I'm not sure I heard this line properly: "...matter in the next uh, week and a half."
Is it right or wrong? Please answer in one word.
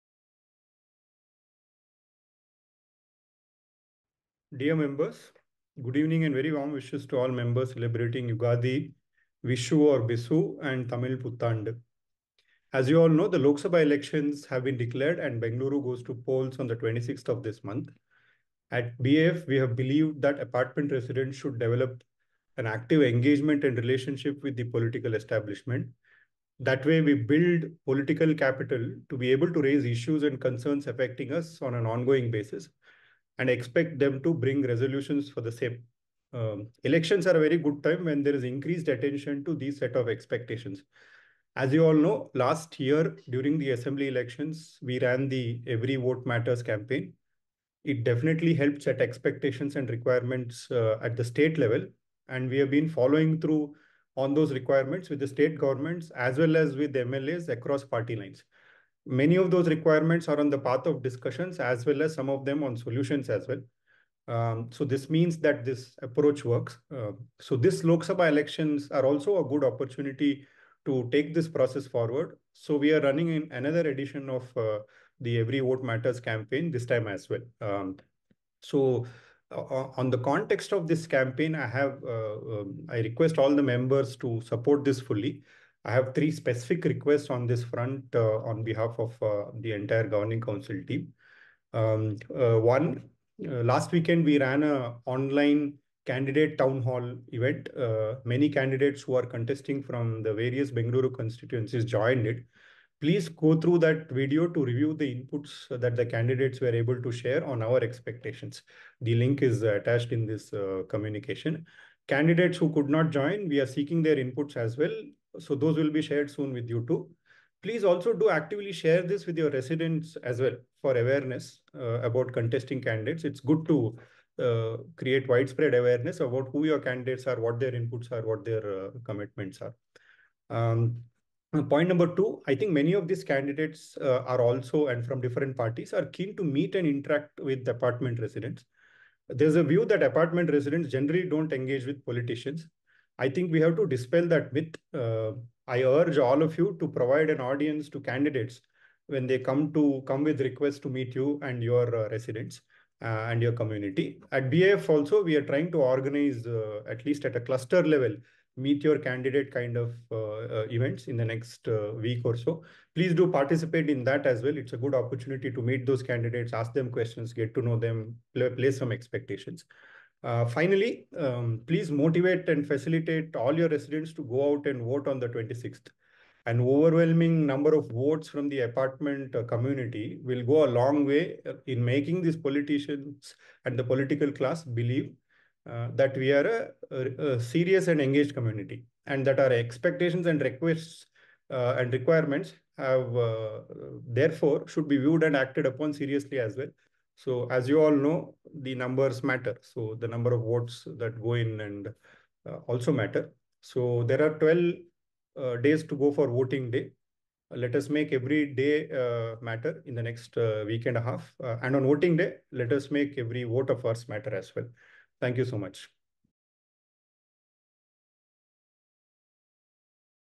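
right.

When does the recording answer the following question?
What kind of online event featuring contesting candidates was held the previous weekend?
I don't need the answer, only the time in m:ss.
1:36.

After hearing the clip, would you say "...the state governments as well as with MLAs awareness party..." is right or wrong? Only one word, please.
wrong.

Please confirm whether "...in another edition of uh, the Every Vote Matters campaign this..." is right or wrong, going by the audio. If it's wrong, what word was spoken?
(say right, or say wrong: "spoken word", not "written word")
right.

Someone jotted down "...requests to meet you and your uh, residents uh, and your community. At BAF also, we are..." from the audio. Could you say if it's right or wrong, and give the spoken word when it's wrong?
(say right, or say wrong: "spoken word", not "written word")
right.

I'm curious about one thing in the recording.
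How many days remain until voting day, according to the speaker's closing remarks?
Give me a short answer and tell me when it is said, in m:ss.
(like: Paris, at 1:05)
12, at 3:24.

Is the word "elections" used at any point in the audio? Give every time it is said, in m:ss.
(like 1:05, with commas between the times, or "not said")
0:13, 0:36, 0:44, 1:08.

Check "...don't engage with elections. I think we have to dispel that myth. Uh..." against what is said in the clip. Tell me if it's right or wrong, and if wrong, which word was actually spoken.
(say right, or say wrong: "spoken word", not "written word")
wrong: "politicians", not "elections".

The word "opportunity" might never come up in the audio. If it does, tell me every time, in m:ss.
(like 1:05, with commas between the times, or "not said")
1:09, 2:44.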